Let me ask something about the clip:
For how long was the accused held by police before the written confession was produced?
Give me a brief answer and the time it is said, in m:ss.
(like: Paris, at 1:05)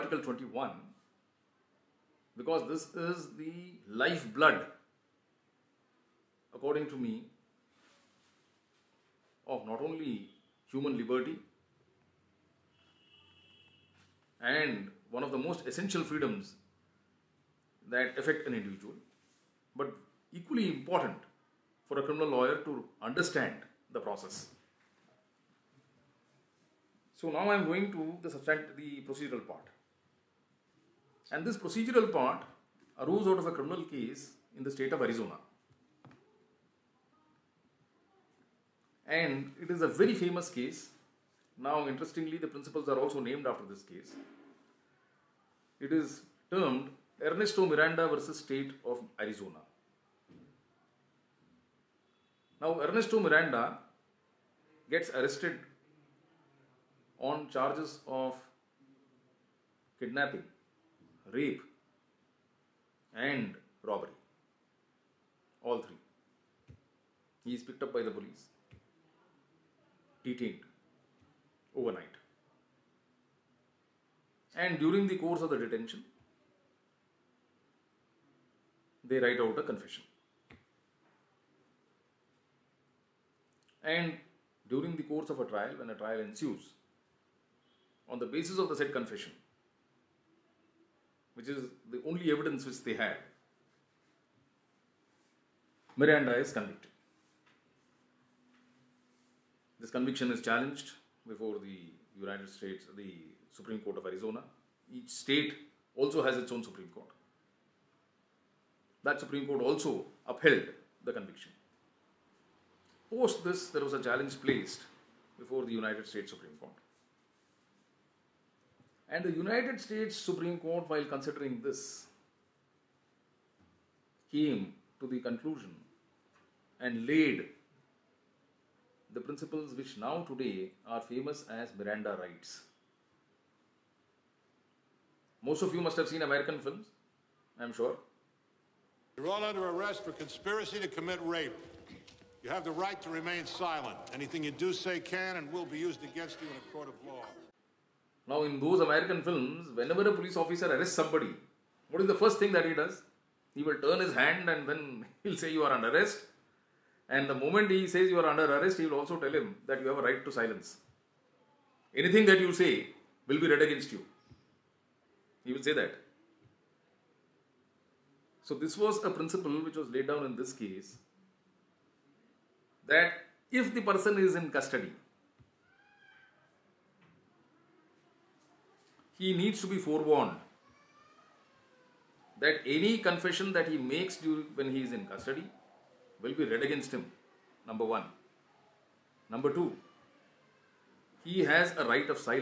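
Overnight, at 1:10.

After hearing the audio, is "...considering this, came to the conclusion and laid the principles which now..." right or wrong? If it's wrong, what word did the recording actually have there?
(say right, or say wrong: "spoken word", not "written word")
right.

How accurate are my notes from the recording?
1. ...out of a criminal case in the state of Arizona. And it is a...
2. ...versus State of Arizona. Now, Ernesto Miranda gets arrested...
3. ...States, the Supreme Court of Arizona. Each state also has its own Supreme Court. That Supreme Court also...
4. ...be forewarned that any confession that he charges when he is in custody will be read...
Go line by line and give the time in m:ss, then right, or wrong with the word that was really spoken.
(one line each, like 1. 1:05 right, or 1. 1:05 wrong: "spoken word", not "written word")
1. 0:33 right
2. 0:48 right
3. 1:42 right
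4. 2:59 wrong: "makes", not "charges".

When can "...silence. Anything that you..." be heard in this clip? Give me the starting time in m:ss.
2:40.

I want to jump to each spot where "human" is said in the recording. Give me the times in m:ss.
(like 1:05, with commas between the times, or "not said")
0:10.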